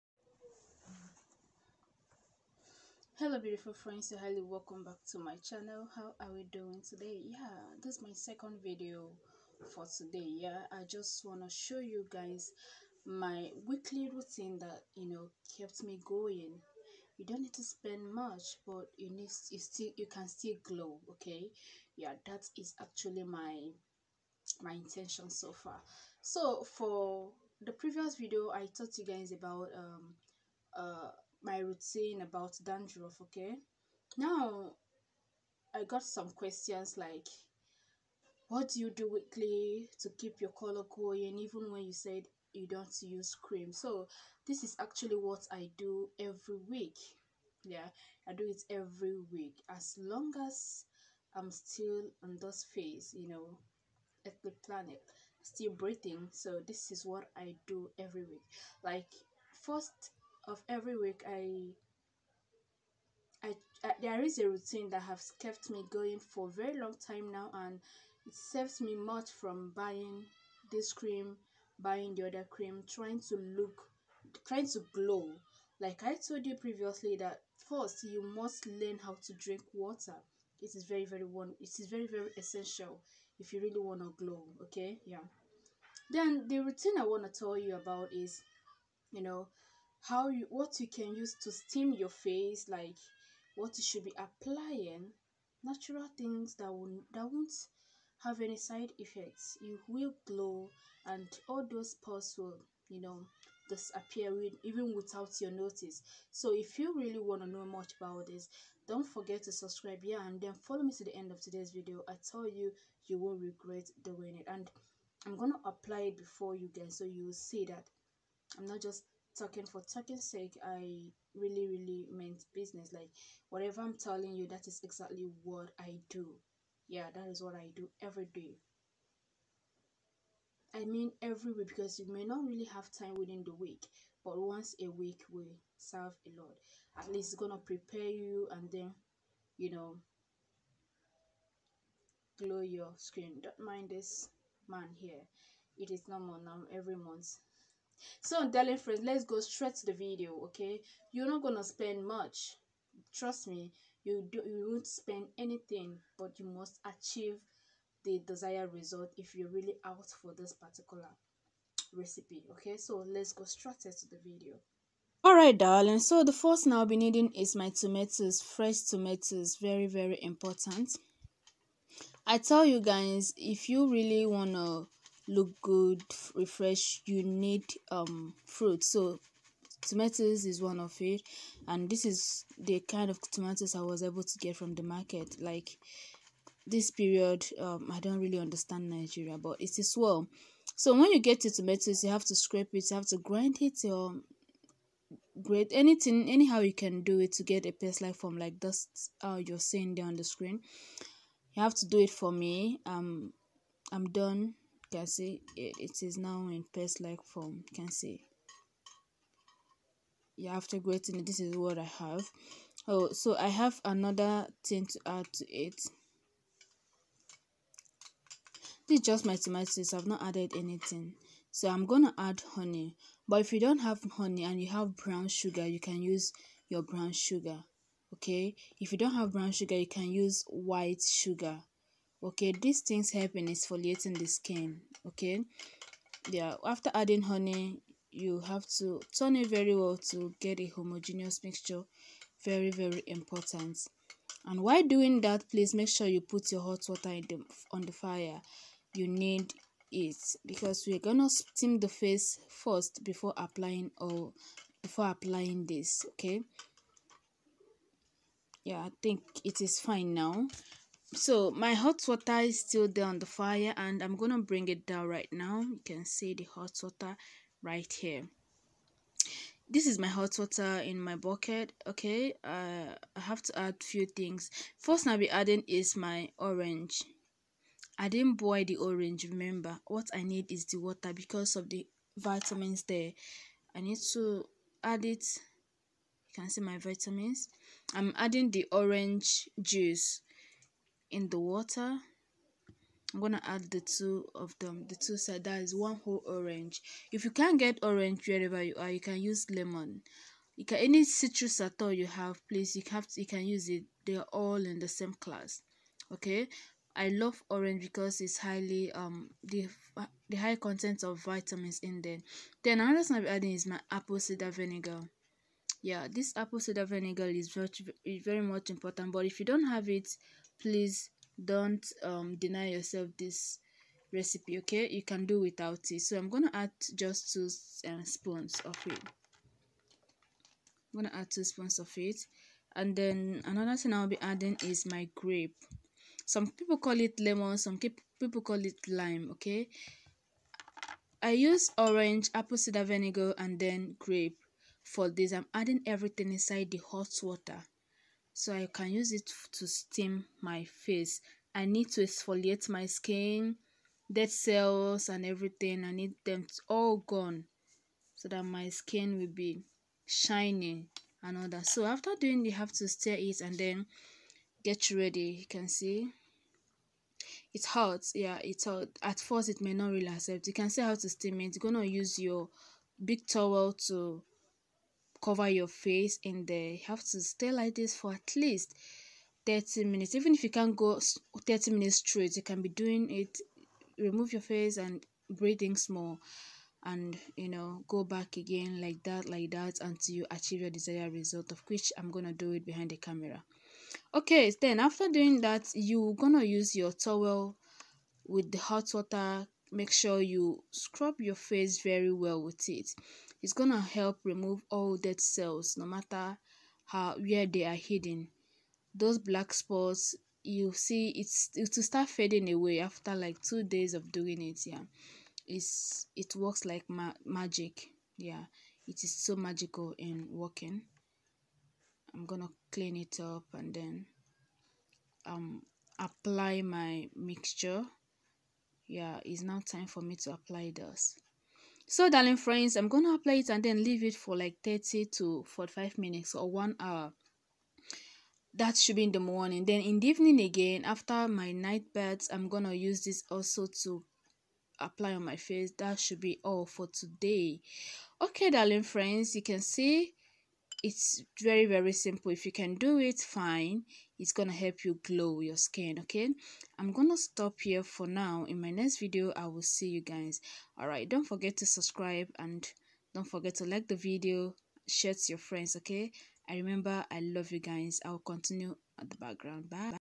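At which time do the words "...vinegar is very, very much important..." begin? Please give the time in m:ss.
5:16.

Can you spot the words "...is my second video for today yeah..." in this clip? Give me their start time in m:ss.
0:07.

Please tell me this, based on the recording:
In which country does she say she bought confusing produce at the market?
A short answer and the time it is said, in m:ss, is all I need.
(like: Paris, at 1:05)
Nigeria, at 3:08.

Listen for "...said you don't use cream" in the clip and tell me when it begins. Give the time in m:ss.
0:41.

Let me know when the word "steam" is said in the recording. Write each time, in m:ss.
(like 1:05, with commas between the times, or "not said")
1:31, 4:11, 5:49, 6:11.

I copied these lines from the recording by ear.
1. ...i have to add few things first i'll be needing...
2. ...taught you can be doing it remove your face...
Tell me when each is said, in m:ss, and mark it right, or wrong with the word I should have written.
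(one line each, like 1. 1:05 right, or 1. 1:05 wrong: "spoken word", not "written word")
1. 4:33 wrong: "adding", not "needing"
2. 6:21 wrong: "straight", not "taught".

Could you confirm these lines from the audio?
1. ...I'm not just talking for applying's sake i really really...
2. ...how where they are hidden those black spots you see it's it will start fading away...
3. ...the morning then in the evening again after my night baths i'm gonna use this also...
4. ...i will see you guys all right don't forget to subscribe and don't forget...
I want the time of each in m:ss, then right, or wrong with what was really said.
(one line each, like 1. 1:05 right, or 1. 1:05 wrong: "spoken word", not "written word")
1. 1:58 wrong: "talking", not "applying"
2. 6:46 right
3. 7:19 right
4. 7:39 right.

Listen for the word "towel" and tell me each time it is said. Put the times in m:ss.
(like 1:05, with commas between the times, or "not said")
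6:13, 6:36.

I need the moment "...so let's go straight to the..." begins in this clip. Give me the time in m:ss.
2:42.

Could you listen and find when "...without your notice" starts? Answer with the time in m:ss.
1:44.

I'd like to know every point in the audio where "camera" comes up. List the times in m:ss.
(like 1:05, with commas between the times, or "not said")
6:32.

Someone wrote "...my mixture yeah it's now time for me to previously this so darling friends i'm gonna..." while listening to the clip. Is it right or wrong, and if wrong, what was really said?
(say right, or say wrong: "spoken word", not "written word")
wrong: "apply", not "previously".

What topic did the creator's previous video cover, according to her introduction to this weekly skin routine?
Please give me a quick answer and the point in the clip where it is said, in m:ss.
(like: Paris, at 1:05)
Dandruff, at 0:32.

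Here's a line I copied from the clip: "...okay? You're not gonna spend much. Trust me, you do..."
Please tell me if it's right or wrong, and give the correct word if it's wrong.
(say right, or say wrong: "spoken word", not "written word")
right.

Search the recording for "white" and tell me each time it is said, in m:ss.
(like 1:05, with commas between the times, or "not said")
3:50.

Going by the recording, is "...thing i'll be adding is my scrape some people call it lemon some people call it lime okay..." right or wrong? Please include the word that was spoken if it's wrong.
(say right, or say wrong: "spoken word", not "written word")
wrong: "grape", not "scrape".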